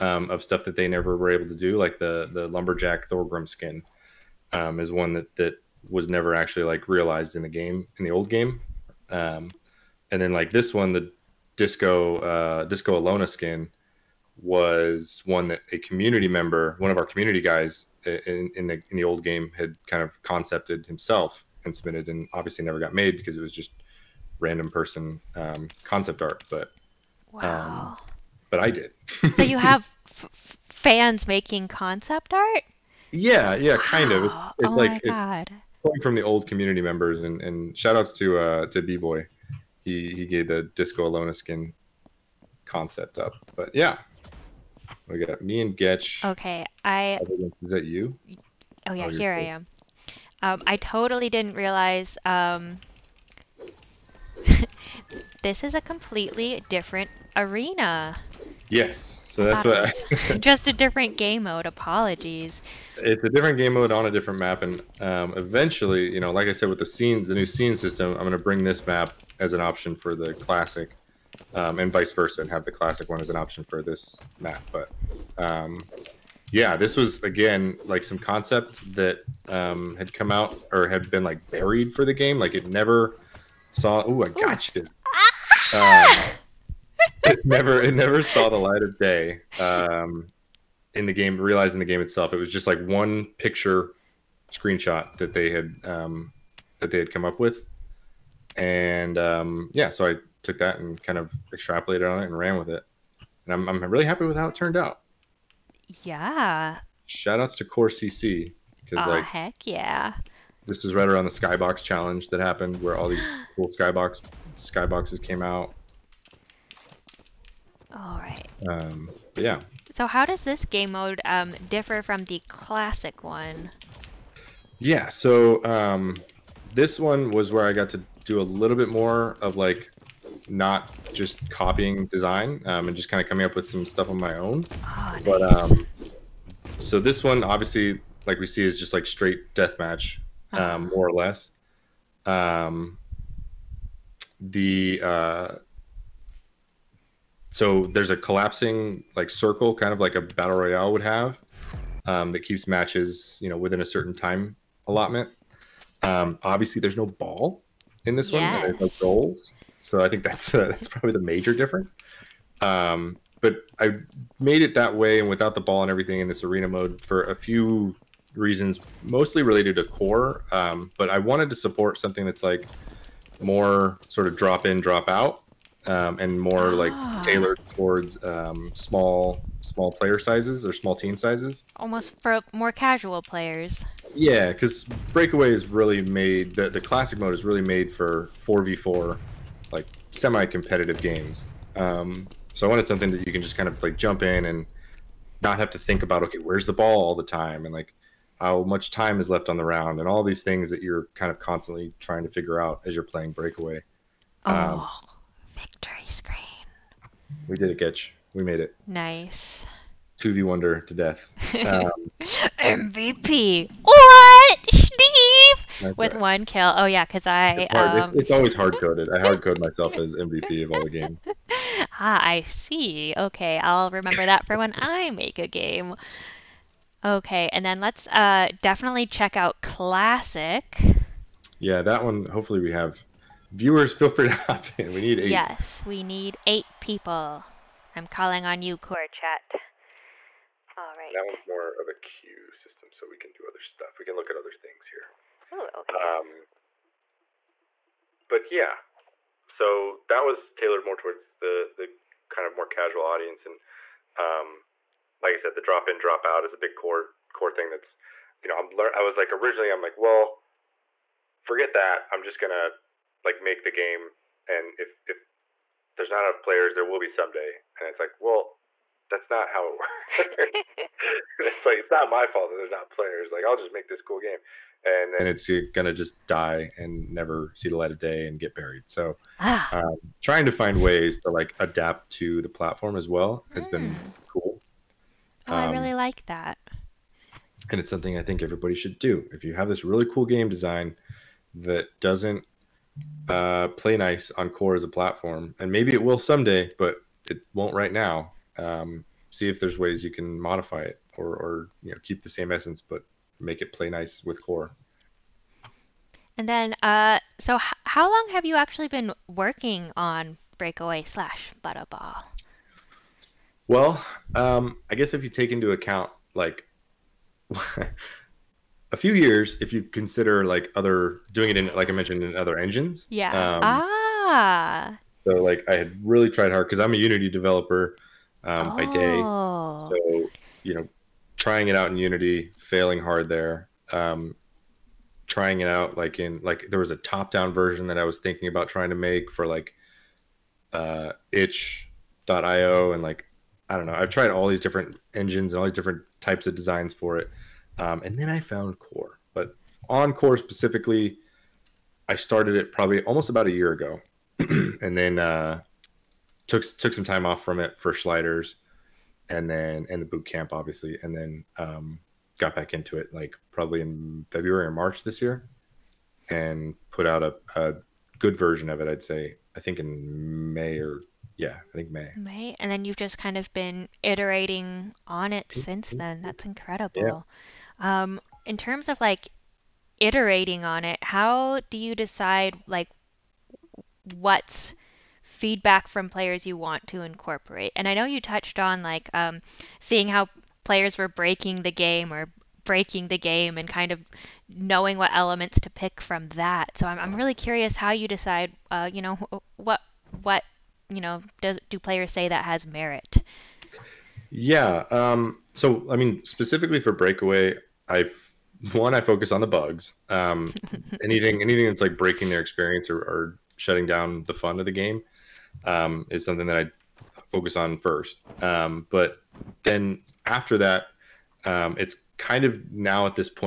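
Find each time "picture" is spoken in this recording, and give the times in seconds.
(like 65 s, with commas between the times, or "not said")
93 s.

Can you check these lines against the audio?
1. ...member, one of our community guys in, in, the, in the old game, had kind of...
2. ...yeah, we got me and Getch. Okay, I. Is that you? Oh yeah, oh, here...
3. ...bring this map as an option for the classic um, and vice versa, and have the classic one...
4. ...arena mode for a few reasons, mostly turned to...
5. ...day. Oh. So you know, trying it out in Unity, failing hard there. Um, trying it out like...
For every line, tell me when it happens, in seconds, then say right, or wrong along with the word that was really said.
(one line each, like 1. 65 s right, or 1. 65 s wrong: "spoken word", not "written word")
1. 16 s right
2. 43 s right
3. 68 s right
4. 166 s wrong: "related", not "turned"
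5. 328 s right.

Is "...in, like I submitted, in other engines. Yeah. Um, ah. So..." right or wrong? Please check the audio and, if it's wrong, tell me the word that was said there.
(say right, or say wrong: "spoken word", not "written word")
wrong: "mentioned", not "submitted".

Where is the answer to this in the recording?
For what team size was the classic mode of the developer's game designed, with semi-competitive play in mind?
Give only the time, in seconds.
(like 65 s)
188 s.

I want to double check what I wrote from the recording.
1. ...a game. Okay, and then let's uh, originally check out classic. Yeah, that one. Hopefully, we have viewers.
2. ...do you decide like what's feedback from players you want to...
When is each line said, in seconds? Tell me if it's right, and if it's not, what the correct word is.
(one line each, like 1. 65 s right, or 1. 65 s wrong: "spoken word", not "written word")
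1. 225 s wrong: "definitely", not "originally"
2. 381 s right.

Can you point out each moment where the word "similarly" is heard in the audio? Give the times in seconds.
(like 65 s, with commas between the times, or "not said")
not said.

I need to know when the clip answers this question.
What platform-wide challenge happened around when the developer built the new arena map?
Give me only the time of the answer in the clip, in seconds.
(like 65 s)
111 s.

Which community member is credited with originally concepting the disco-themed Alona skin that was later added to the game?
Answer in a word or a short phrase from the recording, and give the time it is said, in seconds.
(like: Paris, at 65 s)
B Boy, at 38 s.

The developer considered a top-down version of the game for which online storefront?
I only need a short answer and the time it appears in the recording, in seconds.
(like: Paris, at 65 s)
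itch.io, at 341 s.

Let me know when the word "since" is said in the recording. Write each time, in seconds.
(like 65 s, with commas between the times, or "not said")
375 s.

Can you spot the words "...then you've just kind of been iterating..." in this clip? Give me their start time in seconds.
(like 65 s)
372 s.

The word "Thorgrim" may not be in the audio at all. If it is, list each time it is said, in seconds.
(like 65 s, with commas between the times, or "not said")
3 s.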